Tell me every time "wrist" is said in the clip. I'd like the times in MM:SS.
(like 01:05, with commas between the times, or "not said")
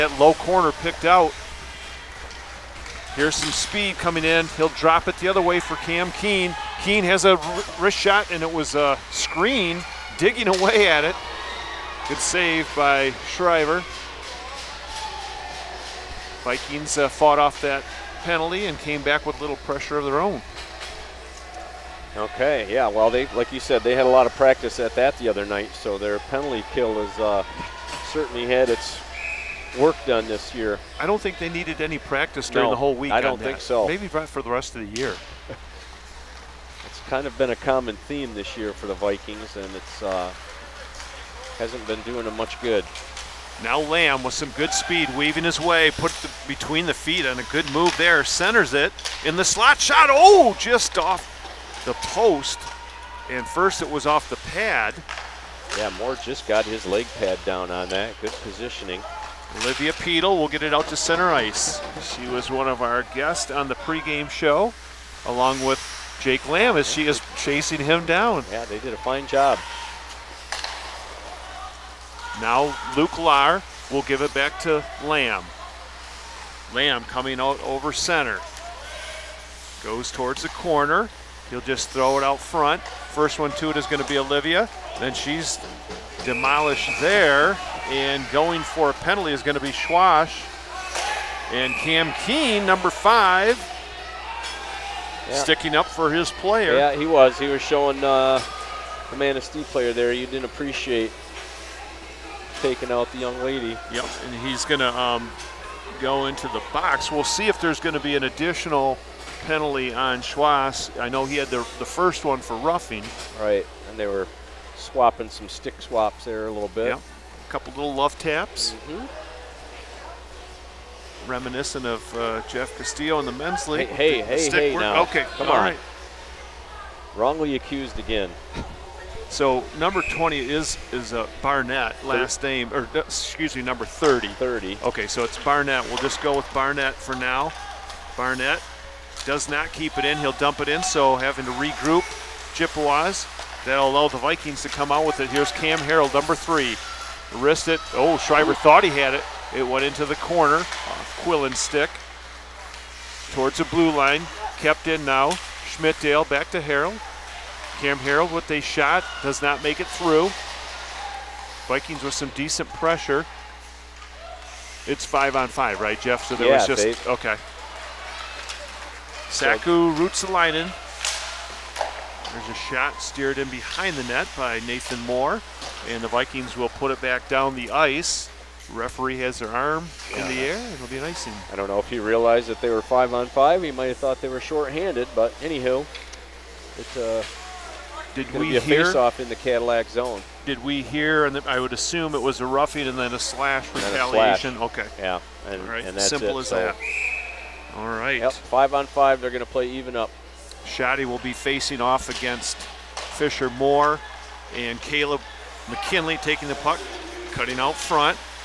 00:07, 02:27.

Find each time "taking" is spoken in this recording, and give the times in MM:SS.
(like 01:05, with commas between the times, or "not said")
01:42, 03:26.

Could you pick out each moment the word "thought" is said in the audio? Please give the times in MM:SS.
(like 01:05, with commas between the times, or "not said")
02:28, 03:03.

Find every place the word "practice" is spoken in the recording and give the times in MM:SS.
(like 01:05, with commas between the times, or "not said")
00:24, 00:31.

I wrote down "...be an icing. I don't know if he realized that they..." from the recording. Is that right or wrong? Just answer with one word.
right.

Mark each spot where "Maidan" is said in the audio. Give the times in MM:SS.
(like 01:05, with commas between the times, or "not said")
not said.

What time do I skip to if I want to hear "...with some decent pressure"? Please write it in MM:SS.
02:42.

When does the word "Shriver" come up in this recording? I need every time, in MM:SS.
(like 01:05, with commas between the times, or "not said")
00:13, 02:28.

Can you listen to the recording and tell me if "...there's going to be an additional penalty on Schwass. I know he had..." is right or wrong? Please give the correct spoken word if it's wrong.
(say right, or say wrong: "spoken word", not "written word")
right.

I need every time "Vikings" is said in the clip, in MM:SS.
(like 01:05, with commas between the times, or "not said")
00:16, 00:38, 02:24, 02:41, 02:56.